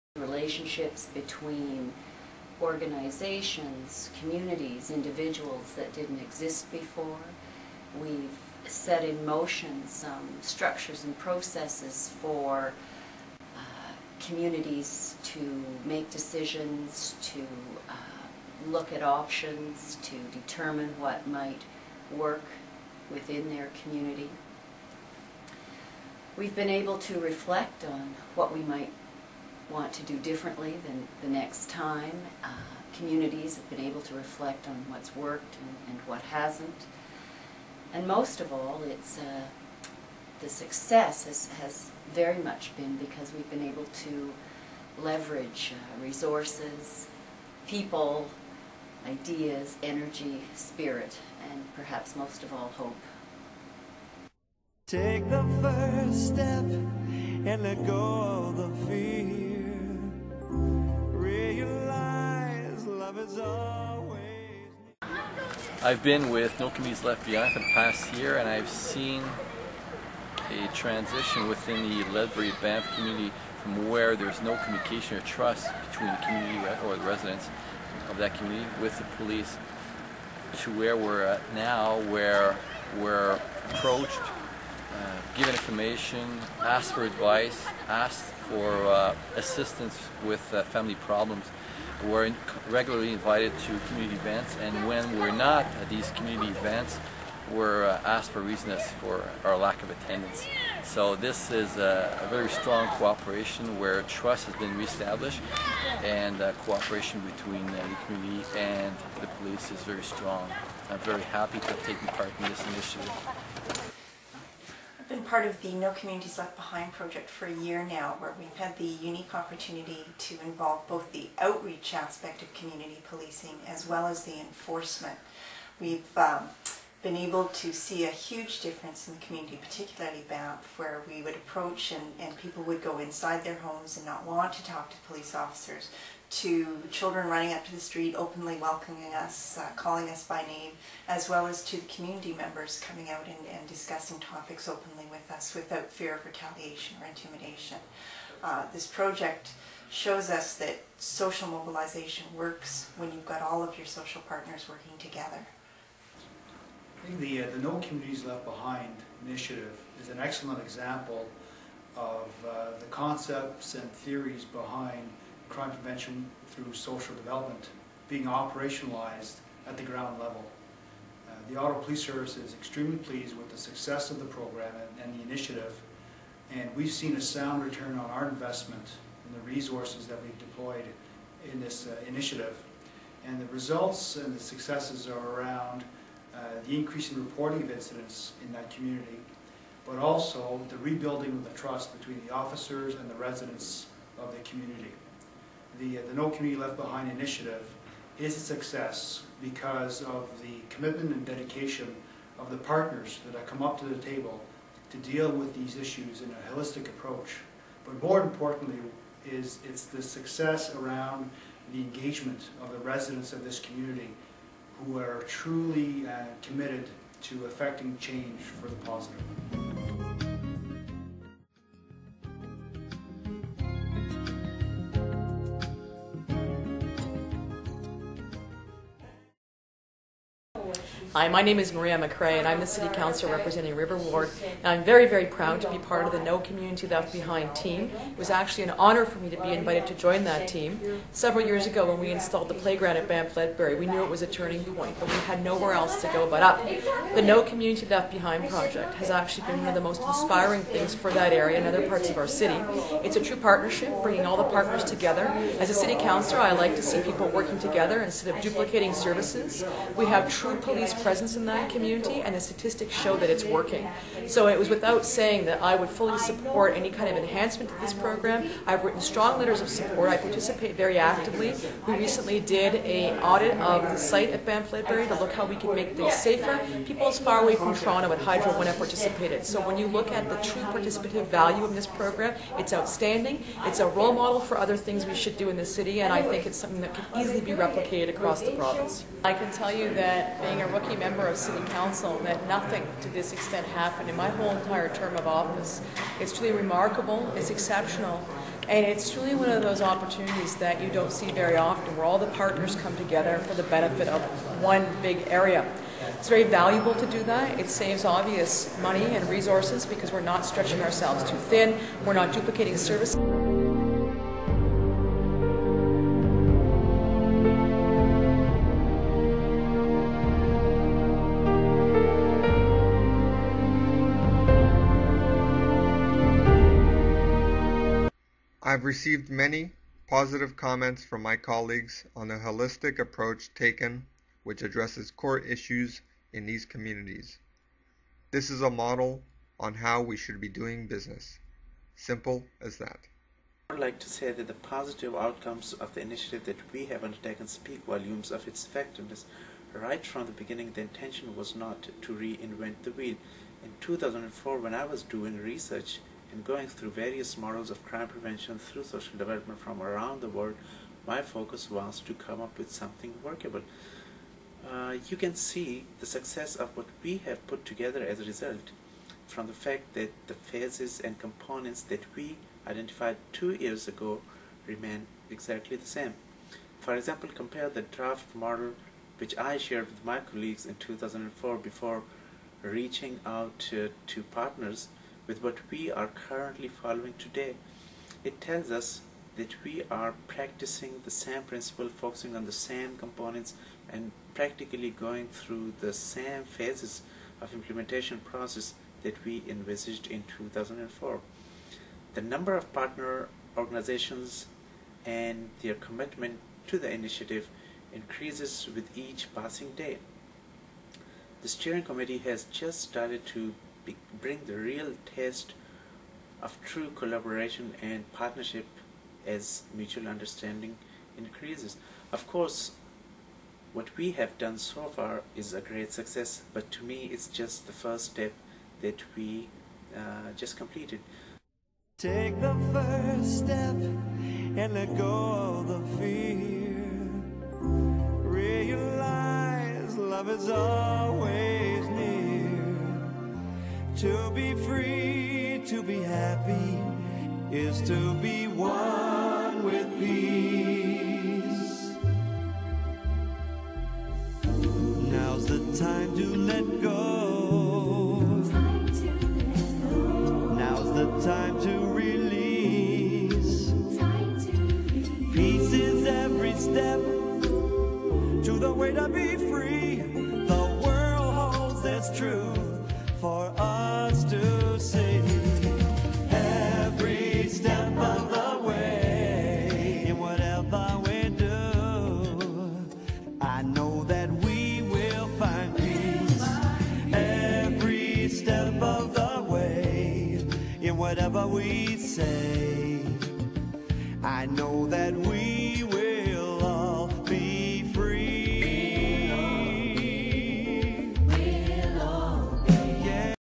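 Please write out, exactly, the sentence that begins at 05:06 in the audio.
It's very valuable to do that.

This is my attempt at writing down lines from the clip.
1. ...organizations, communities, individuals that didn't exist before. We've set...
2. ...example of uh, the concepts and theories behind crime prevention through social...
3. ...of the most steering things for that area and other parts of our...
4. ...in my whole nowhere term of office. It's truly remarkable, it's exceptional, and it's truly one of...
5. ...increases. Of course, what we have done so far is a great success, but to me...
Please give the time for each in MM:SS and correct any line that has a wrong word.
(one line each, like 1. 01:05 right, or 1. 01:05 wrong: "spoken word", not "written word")
1. 00:02 right
2. 02:40 right
3. 04:09 wrong: "inspiring", not "steering"
4. 04:54 wrong: "entire", not "nowhere"
5. 07:01 right.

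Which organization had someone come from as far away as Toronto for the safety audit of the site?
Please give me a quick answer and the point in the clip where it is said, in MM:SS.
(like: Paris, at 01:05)
Hydro, at 04:38.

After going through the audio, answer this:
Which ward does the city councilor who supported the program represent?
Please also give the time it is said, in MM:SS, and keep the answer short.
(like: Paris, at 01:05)
River Ward, at 03:53.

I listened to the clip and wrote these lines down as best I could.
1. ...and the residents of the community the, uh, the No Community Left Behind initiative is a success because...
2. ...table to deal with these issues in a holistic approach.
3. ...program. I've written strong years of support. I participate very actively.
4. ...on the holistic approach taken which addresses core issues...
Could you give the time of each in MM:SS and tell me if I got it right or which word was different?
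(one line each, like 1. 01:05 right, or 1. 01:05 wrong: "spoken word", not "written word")
1. 03:12 right
2. 03:23 right
3. 04:27 wrong: "letters", not "years"
4. 05:32 right.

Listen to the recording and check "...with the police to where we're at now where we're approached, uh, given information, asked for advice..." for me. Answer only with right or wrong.
right.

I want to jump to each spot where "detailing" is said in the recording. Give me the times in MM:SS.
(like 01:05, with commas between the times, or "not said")
not said.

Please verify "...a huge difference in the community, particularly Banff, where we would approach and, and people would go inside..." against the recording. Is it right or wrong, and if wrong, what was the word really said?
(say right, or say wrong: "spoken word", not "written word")
right.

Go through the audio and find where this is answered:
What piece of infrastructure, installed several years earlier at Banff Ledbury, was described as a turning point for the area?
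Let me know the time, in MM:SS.
04:02.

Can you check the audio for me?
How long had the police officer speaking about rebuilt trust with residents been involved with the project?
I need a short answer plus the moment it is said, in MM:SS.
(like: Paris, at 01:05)
1 year, at 01:07.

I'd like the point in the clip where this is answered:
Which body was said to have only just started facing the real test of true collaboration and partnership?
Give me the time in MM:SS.
06:51.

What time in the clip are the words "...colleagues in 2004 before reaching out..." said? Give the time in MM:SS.
06:20.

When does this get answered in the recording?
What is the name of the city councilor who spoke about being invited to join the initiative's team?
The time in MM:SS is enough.
03:51.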